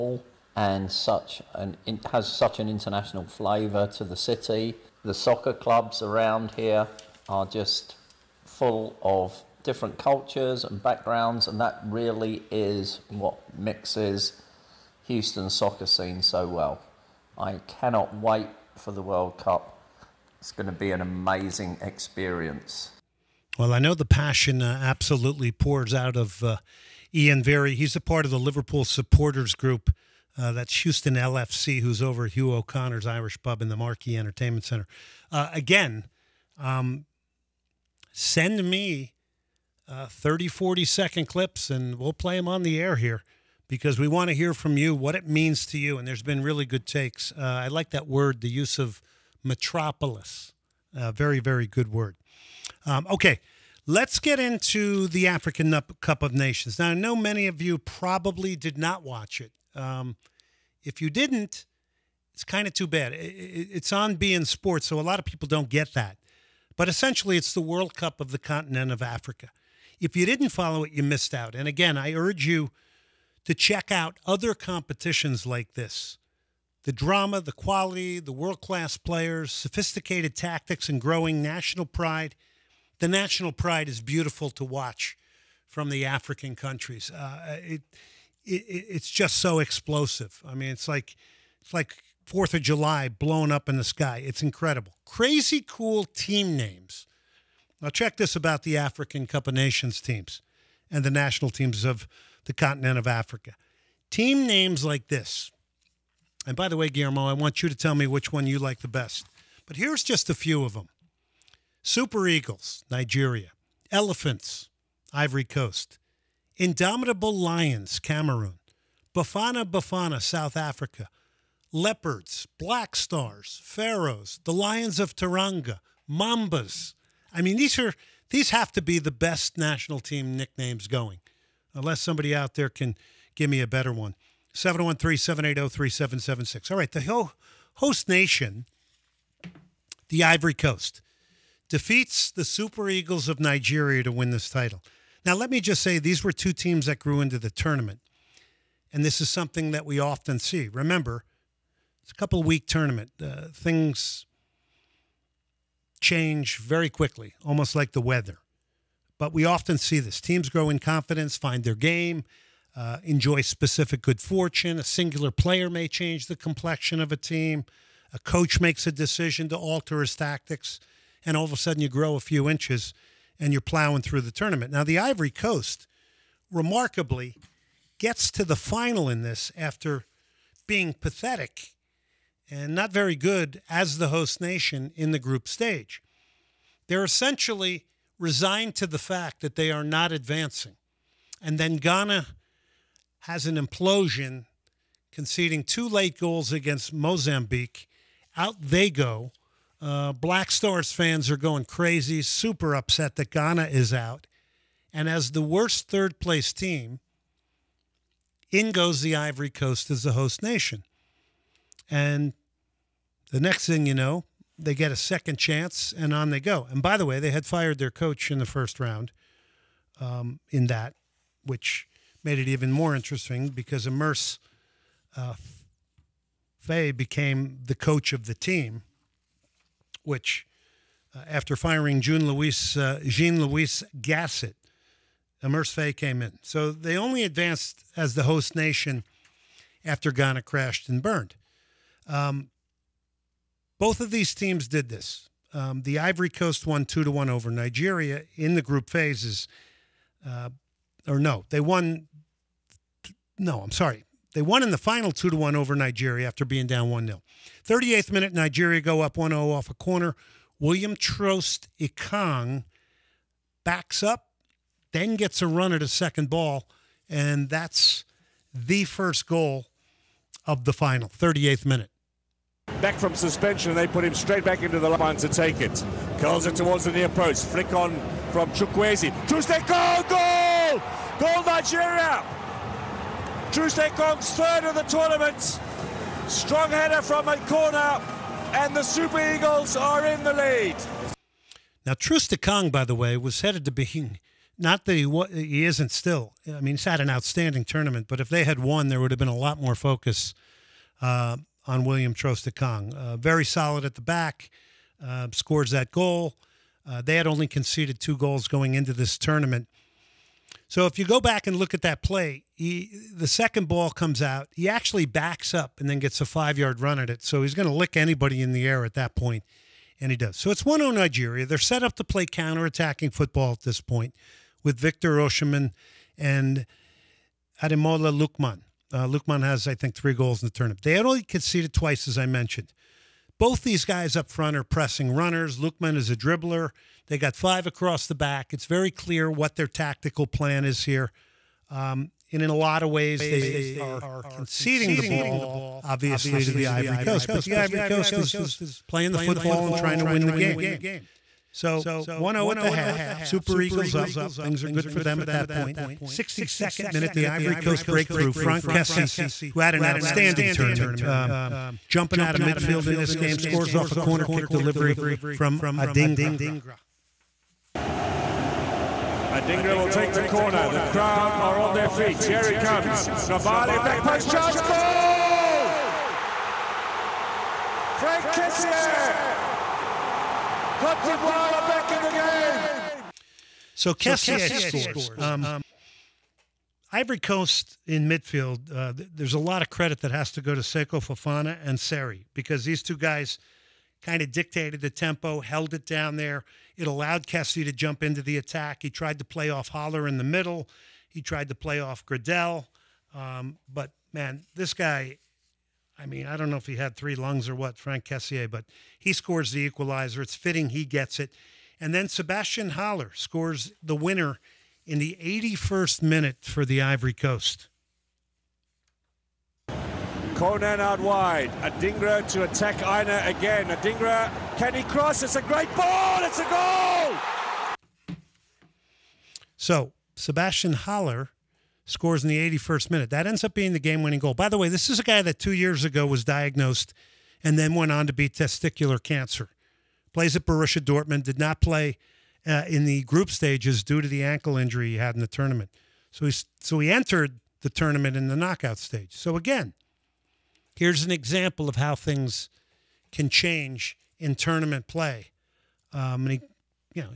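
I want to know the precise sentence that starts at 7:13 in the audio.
That ends up being the game winning goal.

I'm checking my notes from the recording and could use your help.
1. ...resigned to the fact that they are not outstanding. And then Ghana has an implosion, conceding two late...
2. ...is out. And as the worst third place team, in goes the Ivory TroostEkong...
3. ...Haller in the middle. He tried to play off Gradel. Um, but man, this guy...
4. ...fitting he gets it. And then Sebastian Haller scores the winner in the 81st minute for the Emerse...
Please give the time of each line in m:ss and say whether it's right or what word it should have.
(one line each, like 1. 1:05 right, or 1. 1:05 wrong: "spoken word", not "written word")
1. 3:08 wrong: "advancing", not "outstanding"
2. 3:23 wrong: "Coast", not "TroostEkong"
3. 6:39 right
4. 6:50 wrong: "Ivory", not "Emerse".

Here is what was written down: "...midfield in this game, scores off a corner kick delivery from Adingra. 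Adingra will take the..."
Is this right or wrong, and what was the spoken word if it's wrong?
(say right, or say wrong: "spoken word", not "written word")
right.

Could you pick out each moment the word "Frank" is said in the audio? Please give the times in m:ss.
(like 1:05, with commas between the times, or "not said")
5:58, 6:17, 6:47.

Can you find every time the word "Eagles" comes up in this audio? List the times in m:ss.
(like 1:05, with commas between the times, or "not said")
1:52, 2:22, 4:49, 5:53.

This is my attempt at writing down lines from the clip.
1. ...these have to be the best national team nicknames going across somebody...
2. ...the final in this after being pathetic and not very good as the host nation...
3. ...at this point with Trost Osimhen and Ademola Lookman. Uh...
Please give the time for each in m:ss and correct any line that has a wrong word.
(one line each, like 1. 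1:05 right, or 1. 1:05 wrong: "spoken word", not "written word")
1. 2:08 wrong: "unless", not "across"
2. 2:58 right
3. 5:23 wrong: "Victor", not "Trost".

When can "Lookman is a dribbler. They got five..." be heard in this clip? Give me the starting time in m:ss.
5:35.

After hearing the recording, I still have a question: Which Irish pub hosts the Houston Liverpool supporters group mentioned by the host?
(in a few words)
Hugh O'Connor's Irish Pub.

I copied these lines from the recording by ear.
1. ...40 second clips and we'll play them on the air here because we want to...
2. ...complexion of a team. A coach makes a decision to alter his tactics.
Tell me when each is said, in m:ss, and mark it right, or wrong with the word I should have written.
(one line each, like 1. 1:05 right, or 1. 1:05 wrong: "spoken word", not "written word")
1. 0:40 right
2. 2:46 right.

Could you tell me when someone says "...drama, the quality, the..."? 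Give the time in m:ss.
1:16.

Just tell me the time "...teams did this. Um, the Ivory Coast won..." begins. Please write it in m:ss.
4:04.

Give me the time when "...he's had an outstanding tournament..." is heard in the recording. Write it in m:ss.
4:56.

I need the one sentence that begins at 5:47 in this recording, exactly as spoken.
But the Ivory Coast is playing the football and trying to win the game.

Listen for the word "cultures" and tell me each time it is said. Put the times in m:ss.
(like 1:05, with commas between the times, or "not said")
0:09.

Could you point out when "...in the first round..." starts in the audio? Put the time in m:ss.
3:38.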